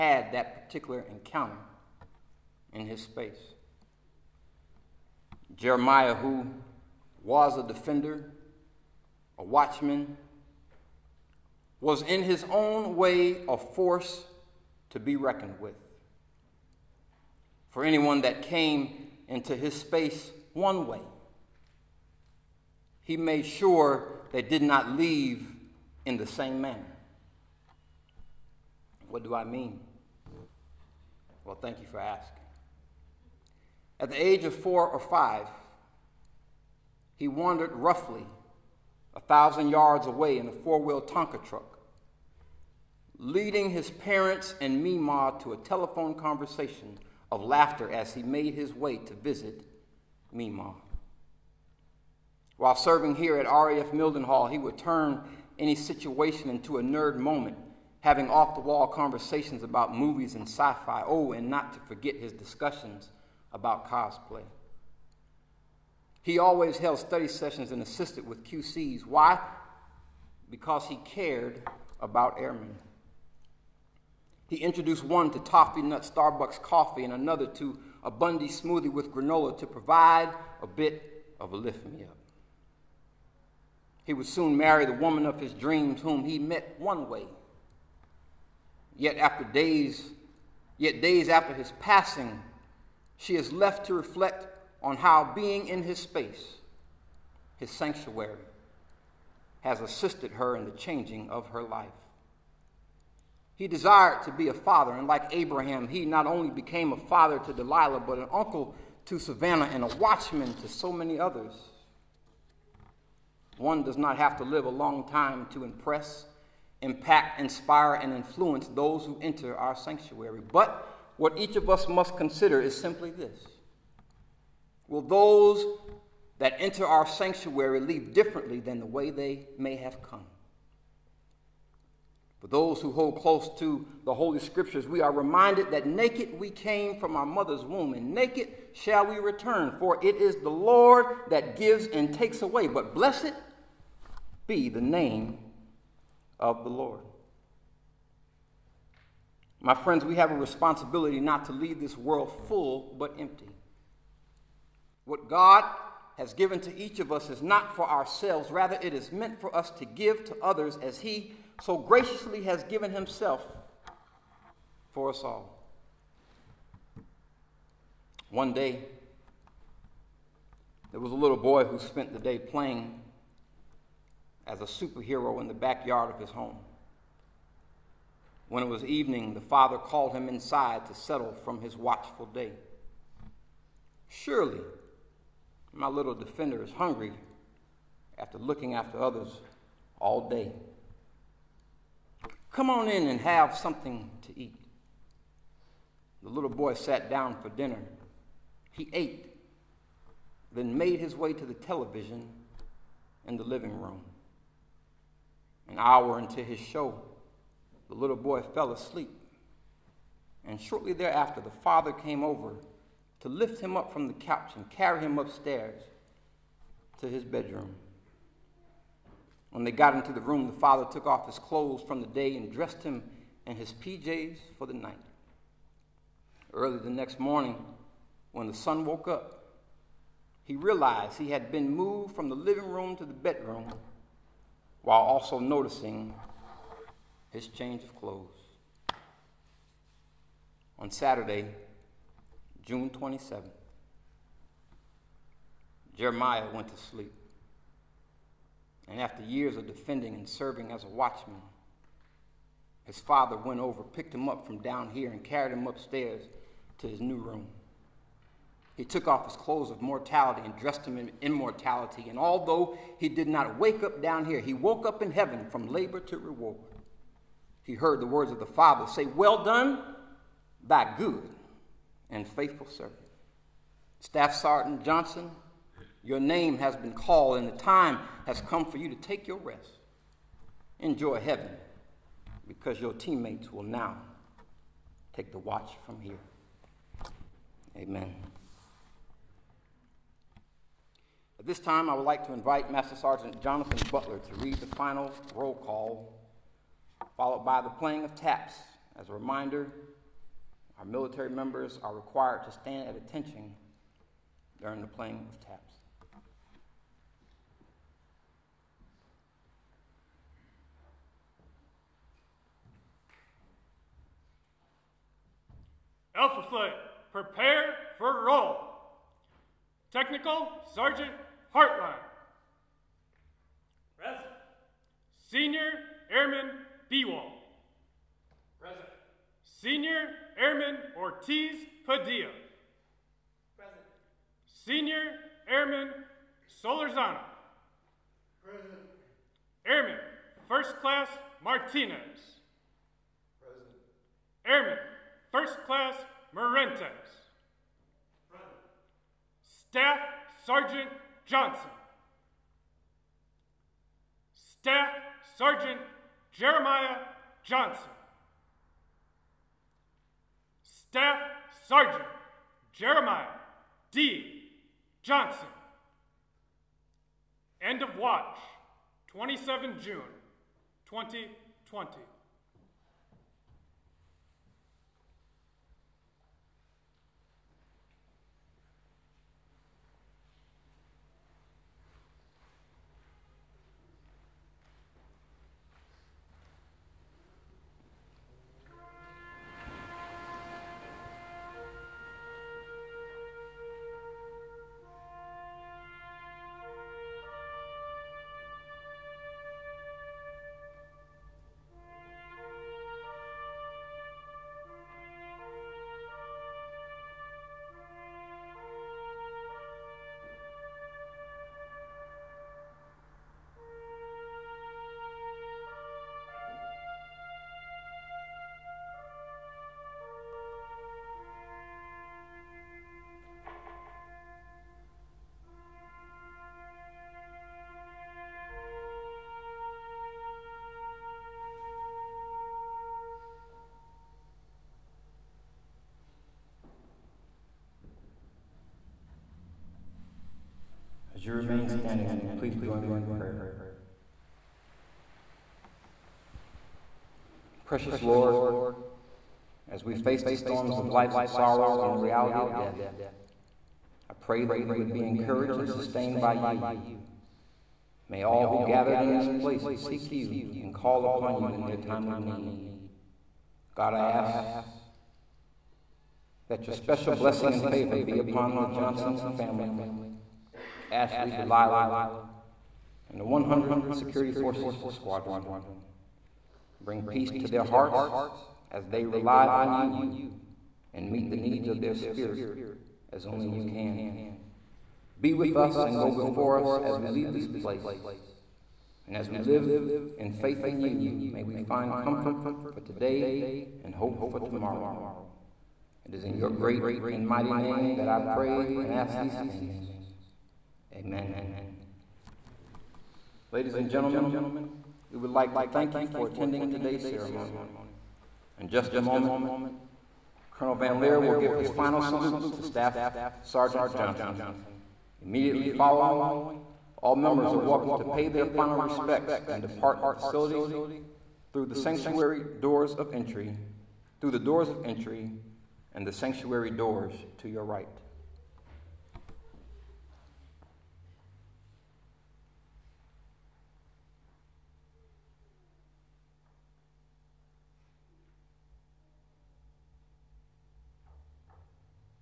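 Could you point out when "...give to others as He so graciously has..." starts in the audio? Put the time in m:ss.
2:39.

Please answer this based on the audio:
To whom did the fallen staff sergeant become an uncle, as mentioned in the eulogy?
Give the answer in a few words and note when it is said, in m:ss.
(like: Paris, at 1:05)
Savannah, at 1:49.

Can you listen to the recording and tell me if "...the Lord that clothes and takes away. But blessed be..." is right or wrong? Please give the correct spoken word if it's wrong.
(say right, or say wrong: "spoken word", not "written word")
wrong: "gives", not "clothes".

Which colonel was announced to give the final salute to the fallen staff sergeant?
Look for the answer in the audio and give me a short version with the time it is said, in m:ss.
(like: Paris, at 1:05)
Colonel Van Leer, at 8:30.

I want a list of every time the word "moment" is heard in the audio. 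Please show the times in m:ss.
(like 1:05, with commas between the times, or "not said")
0:57, 8:28.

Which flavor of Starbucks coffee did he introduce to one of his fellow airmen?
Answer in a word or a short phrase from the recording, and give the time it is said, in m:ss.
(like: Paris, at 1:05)
toffee nut, at 1:15.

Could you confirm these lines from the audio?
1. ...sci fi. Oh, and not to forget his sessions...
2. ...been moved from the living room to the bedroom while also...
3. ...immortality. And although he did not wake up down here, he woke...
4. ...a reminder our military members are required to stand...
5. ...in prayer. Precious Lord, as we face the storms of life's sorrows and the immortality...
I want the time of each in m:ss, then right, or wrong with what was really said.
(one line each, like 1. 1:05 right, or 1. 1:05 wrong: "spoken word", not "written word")
1. 1:00 wrong: "discussions", not "sessions"
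2. 3:51 right
3. 4:21 right
4. 4:59 right
5. 7:22 wrong: "reality", not "immortality".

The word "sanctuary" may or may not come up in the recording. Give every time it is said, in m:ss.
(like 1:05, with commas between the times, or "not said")
1:37, 1:59, 2:07, 8:41, 8:46.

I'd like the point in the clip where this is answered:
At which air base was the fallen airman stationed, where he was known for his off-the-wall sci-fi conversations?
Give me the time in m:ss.
0:53.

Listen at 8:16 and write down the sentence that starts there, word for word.
It is in your great and mighty name that I pray and ask these things.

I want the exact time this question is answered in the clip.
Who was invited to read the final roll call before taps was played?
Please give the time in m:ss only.
4:53.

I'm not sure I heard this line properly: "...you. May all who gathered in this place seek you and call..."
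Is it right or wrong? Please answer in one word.
right.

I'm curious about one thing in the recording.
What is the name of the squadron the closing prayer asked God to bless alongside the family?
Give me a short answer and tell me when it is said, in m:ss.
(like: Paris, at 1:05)
100th Security Forces Squadron, at 7:53.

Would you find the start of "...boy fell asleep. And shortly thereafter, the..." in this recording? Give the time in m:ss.
3:28.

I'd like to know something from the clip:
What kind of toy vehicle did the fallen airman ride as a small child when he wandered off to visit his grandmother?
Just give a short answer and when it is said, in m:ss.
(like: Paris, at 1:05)
Tonka truck, at 0:41.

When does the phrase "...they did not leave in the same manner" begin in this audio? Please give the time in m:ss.
0:24.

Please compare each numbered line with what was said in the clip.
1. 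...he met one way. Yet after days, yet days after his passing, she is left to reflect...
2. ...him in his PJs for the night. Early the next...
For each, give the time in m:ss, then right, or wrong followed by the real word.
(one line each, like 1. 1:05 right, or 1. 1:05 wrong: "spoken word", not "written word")
1. 1:26 right
2. 3:42 right.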